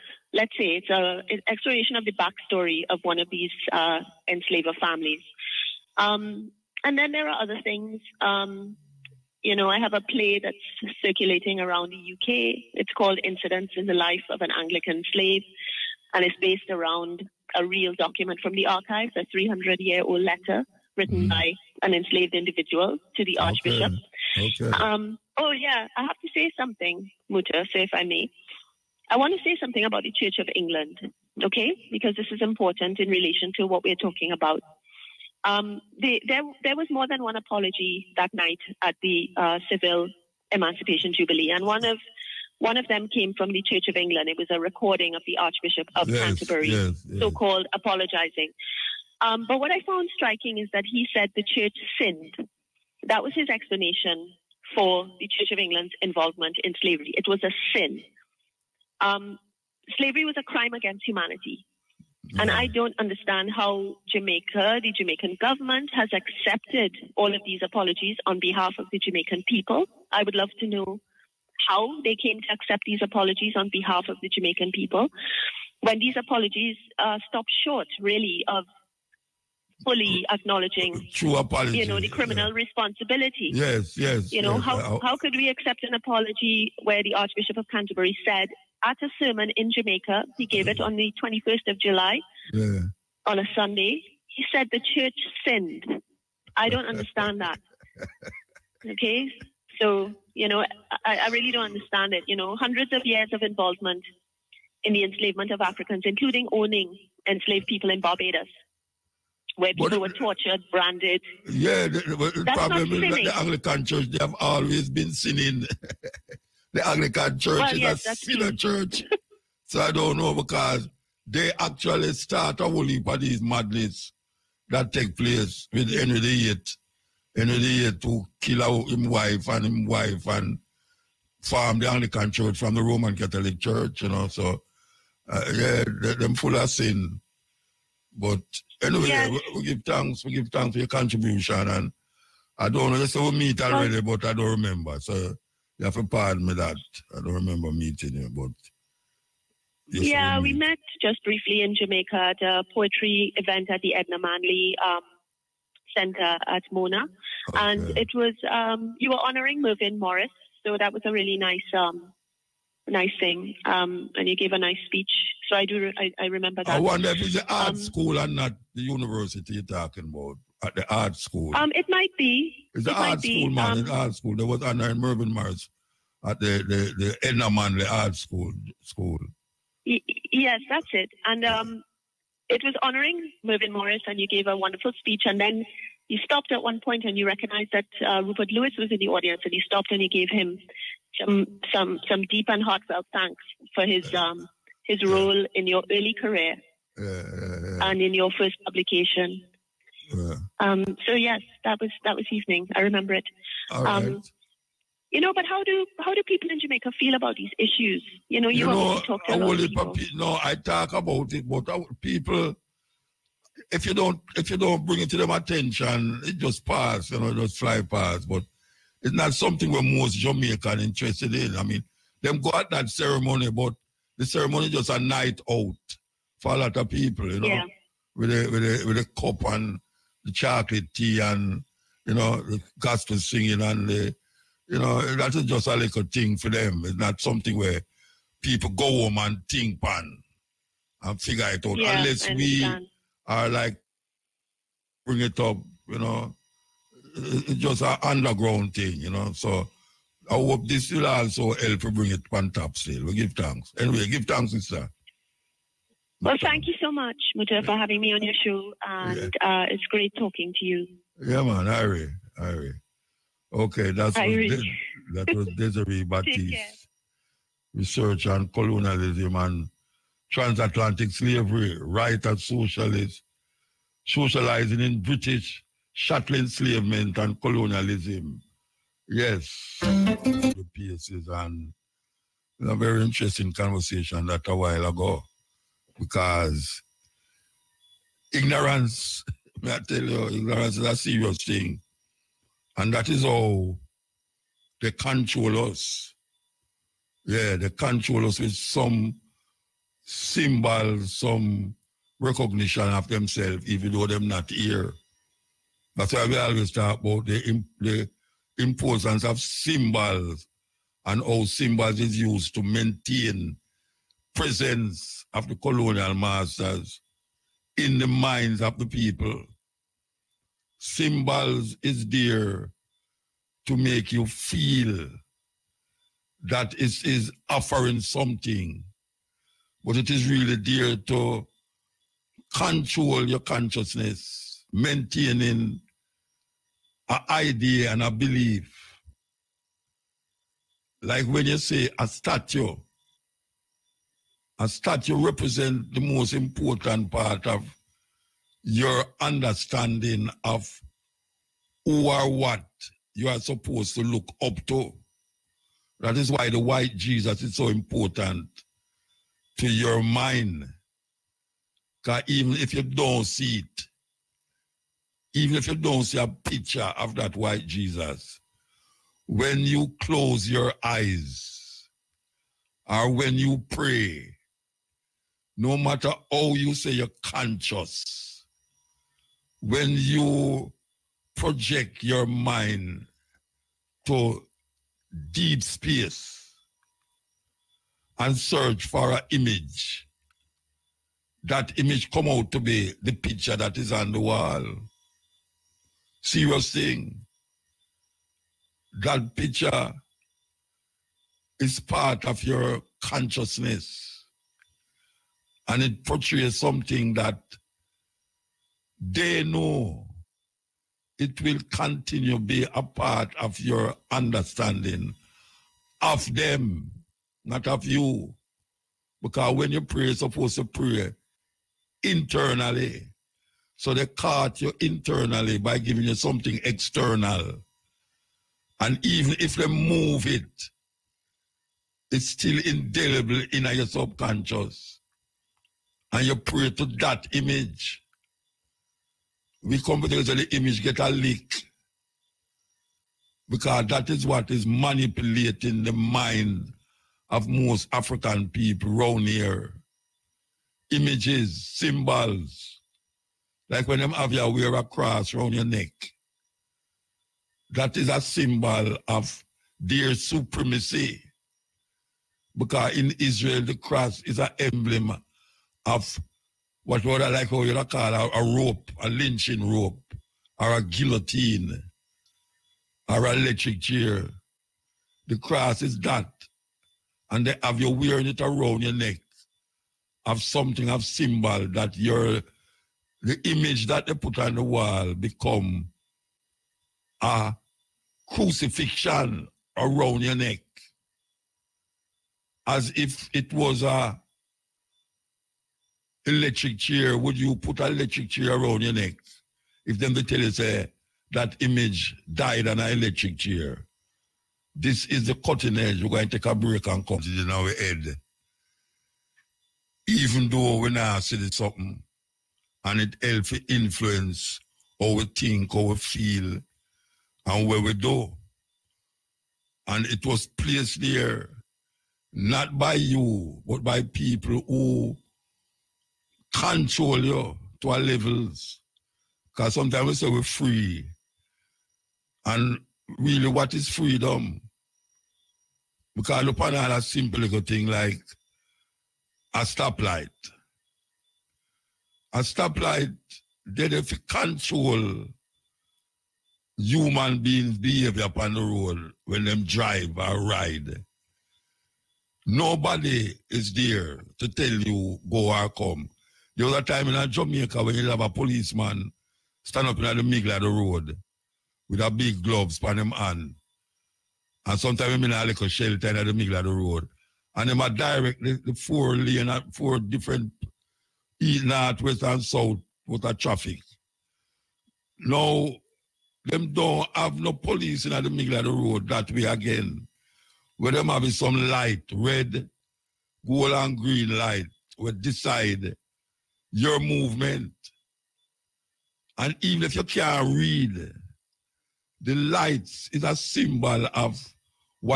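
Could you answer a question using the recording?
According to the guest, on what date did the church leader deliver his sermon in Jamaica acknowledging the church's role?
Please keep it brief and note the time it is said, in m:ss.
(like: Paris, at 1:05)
21 July, at 1:31.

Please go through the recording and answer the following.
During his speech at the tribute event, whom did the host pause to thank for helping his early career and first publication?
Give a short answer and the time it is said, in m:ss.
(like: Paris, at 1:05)
Rupert Lewis, at 3:08.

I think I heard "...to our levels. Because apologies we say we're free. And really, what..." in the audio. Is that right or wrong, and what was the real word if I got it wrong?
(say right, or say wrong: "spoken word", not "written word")
wrong: "sometimes", not "apologies".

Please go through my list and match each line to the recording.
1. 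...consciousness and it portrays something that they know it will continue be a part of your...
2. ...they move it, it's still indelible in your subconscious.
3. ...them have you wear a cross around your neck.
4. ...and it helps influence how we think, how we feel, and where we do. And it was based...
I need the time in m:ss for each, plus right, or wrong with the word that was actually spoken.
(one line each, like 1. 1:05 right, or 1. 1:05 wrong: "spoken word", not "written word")
1. 6:43 right
2. 7:09 right
3. 7:33 right
4. 8:32 wrong: "placed", not "based".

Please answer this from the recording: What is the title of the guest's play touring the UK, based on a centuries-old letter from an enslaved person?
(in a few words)
Incidents in the Life of an Anglican Slave.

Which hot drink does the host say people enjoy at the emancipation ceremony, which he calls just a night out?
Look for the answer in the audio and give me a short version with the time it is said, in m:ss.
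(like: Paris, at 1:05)
chocolate tea, at 3:50.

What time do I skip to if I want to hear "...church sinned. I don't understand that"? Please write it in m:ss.
1:34.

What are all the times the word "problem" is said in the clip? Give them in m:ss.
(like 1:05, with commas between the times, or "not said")
1:52.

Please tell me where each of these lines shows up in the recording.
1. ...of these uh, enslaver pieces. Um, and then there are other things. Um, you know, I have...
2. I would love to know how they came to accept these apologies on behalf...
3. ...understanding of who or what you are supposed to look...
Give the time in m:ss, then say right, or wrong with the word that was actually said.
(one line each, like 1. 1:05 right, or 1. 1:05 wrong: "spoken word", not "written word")
1. 0:03 wrong: "families", not "pieces"
2. 1:10 right
3. 5:49 right.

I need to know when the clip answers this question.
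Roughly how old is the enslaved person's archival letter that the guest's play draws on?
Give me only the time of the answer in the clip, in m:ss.
0:19.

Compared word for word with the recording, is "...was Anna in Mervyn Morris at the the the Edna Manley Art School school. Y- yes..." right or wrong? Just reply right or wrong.
right.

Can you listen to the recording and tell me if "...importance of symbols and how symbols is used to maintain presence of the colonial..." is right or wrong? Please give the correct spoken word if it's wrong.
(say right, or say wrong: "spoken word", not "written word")
right.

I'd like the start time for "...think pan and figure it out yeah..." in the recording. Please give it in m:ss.
3:59.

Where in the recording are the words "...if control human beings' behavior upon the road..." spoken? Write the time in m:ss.
9:03.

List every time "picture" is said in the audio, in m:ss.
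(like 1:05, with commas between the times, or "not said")
6:06, 6:33, 6:39.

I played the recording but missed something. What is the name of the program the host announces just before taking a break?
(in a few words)
The Cutting Edge.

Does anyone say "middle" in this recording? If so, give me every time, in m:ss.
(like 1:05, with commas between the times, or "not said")
9:20, 9:26, 9:38.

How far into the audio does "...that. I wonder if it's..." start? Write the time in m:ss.
2:46.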